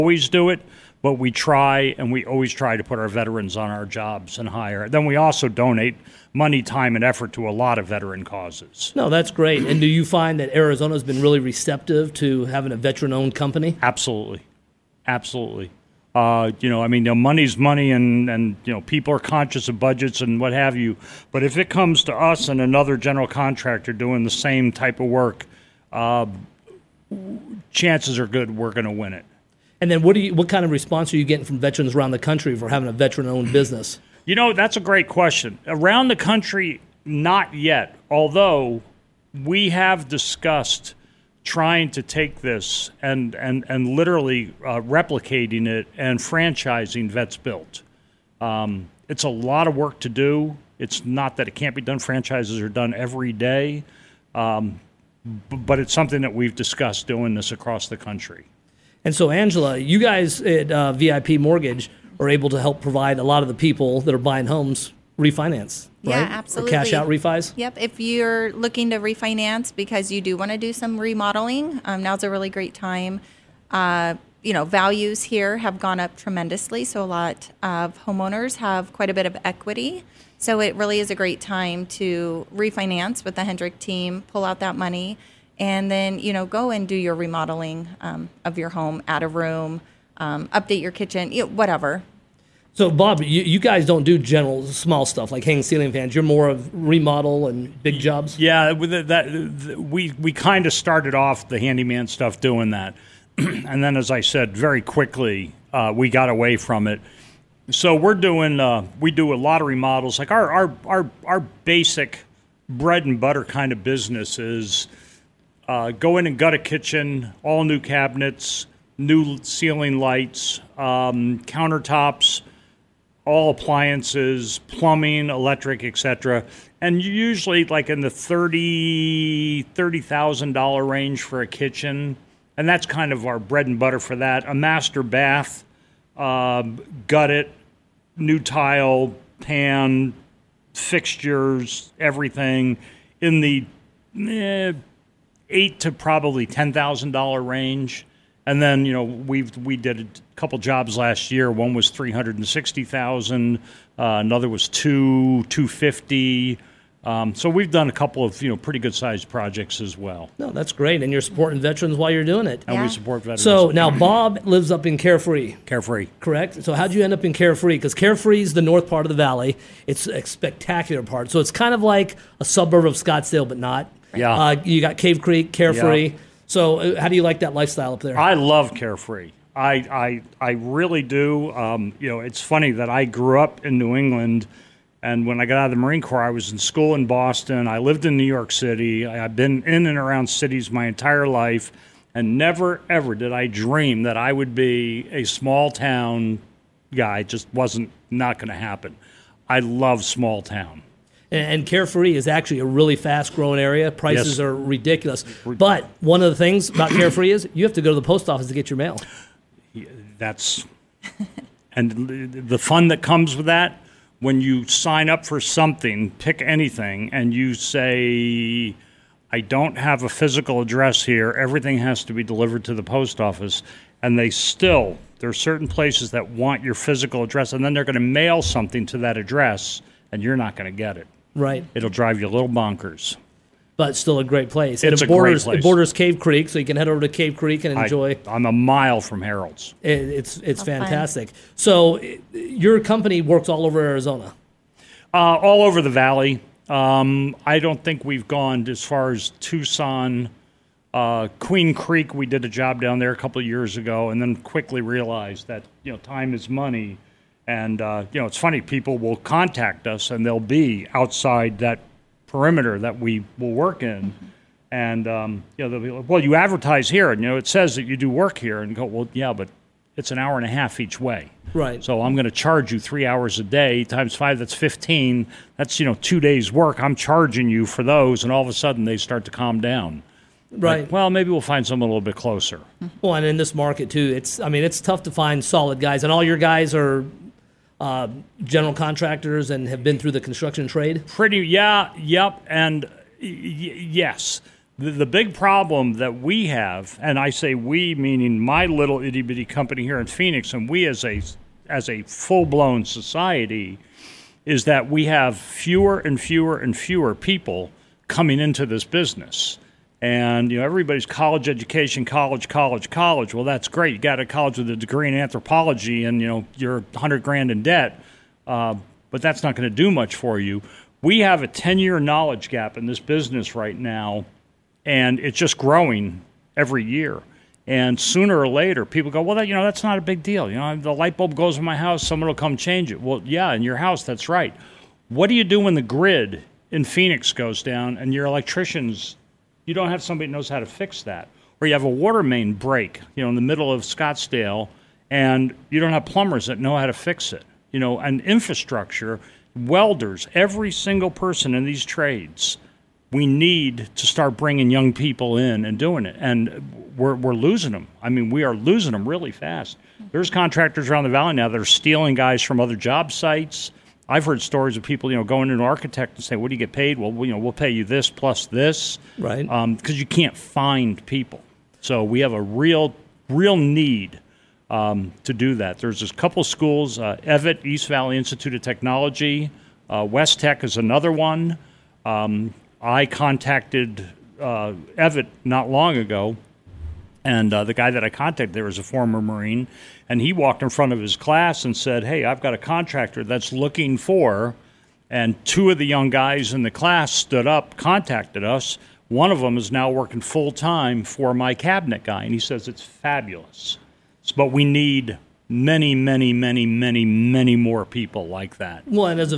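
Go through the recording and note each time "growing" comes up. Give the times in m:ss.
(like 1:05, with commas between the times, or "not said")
3:23, 5:25.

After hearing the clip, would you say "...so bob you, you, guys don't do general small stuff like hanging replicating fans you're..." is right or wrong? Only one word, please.
wrong.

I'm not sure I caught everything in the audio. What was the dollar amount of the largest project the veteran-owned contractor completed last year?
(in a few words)
$360,000.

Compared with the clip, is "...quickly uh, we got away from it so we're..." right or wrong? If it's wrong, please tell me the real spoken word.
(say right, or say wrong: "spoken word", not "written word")
right.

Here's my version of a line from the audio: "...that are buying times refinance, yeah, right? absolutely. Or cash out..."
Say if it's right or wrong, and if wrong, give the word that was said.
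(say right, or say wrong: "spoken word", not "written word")
wrong: "homes", not "times".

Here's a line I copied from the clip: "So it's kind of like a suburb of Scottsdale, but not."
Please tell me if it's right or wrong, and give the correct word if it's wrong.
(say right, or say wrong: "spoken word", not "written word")
right.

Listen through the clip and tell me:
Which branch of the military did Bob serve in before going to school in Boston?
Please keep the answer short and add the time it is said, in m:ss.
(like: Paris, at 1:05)
Marine Corps, at 3:05.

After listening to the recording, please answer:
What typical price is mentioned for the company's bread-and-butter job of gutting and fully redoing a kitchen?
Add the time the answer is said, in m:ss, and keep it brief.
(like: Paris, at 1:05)
$30,000, at 2:09.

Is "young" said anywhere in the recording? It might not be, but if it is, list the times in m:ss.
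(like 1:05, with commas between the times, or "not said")
5:54, 6:35.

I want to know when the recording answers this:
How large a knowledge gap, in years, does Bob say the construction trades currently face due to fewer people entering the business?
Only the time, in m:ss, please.
5:21.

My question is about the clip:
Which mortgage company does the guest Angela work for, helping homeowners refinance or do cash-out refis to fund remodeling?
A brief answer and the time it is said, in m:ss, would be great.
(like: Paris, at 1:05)
VIP Mortgage, at 1:00.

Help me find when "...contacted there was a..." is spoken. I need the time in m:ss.
6:28.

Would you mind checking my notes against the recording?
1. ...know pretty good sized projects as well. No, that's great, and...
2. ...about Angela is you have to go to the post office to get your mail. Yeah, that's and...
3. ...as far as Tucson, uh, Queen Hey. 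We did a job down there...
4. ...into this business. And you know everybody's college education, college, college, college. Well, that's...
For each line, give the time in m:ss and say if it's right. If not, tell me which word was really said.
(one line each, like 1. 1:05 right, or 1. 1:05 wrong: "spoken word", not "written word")
1. 2:38 right
2. 3:26 wrong: "Carefree", not "Angela"
3. 4:08 wrong: "Creek", not "Hey"
4. 5:08 right.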